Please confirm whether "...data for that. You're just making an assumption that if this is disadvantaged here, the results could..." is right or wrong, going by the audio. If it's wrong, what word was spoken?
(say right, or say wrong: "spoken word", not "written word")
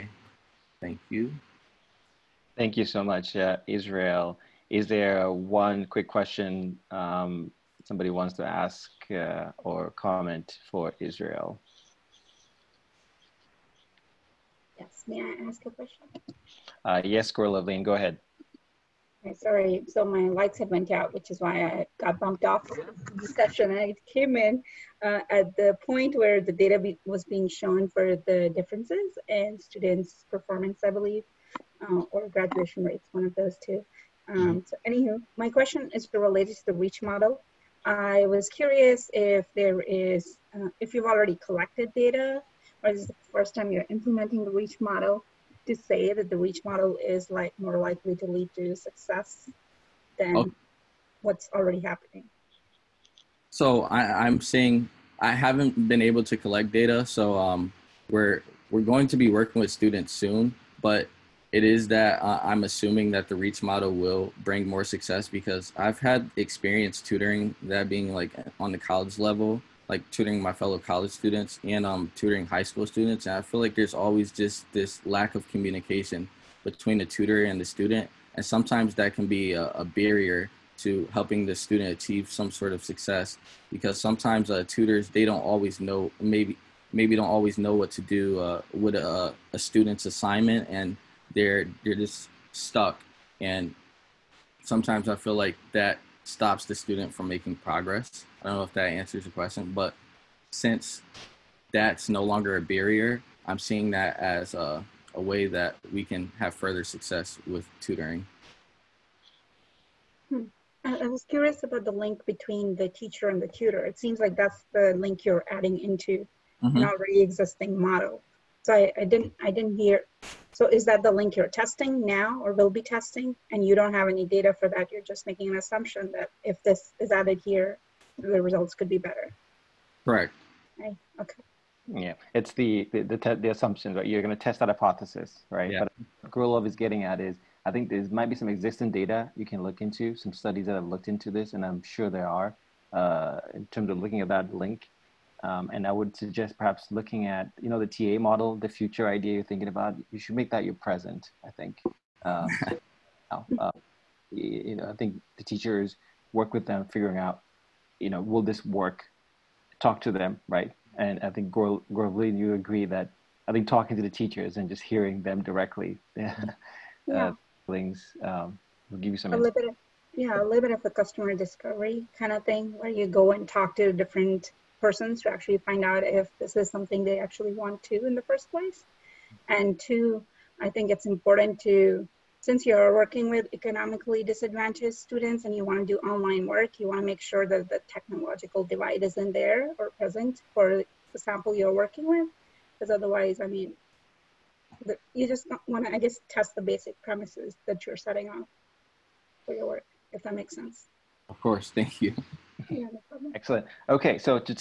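wrong: "added", not "disadvantaged".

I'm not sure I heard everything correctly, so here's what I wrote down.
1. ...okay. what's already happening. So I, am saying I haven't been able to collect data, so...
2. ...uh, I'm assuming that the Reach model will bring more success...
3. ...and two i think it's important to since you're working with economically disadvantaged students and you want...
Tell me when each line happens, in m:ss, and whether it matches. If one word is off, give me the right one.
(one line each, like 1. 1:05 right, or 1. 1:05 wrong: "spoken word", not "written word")
1. 0:50 right
2. 1:02 right
3. 2:59 right.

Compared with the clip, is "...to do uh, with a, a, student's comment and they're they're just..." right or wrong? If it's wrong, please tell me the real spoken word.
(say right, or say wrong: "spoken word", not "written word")
wrong: "assignment", not "comment".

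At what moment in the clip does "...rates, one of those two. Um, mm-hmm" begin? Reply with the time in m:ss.
0:32.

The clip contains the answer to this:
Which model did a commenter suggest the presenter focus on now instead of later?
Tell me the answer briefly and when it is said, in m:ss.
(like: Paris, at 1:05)
TA model, at 2:27.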